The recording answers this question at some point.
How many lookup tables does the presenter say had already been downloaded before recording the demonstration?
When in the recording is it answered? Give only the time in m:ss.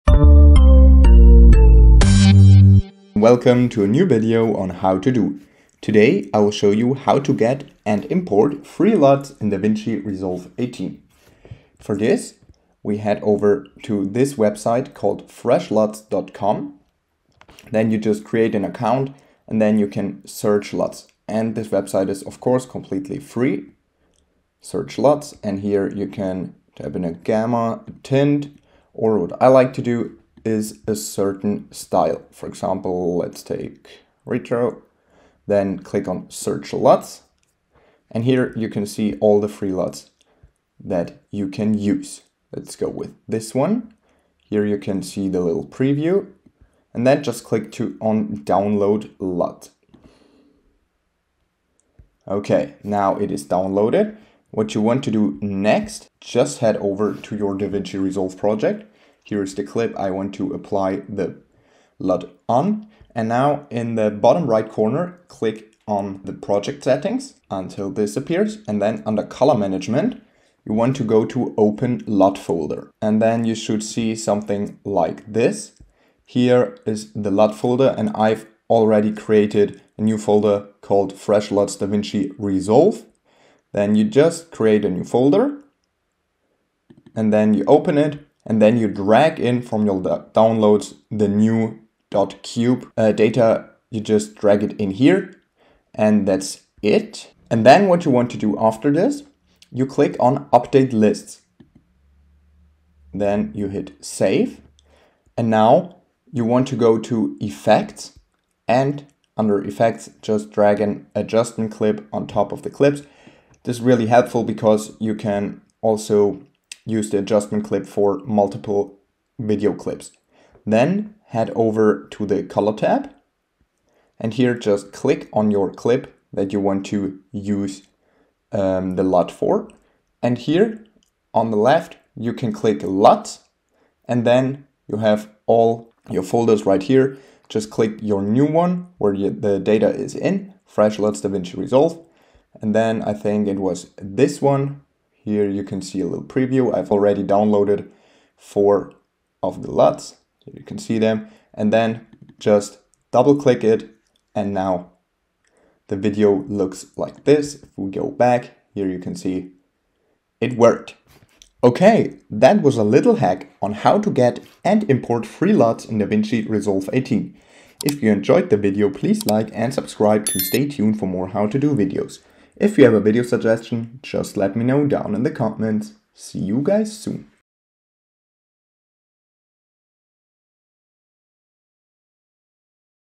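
2:28.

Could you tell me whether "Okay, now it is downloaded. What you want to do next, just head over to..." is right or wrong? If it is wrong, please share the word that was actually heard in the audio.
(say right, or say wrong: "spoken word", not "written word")
right.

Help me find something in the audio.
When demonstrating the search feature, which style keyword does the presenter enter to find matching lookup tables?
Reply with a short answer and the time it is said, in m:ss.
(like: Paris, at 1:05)
retro, at 0:34.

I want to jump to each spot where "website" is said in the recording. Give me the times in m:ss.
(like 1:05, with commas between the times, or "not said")
0:14, 0:21.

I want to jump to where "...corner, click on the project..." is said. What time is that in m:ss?
1:04.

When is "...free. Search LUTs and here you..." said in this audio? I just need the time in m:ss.
0:23.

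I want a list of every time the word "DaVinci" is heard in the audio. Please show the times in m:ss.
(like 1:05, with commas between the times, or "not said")
0:09, 0:57, 1:21, 2:21, 2:45.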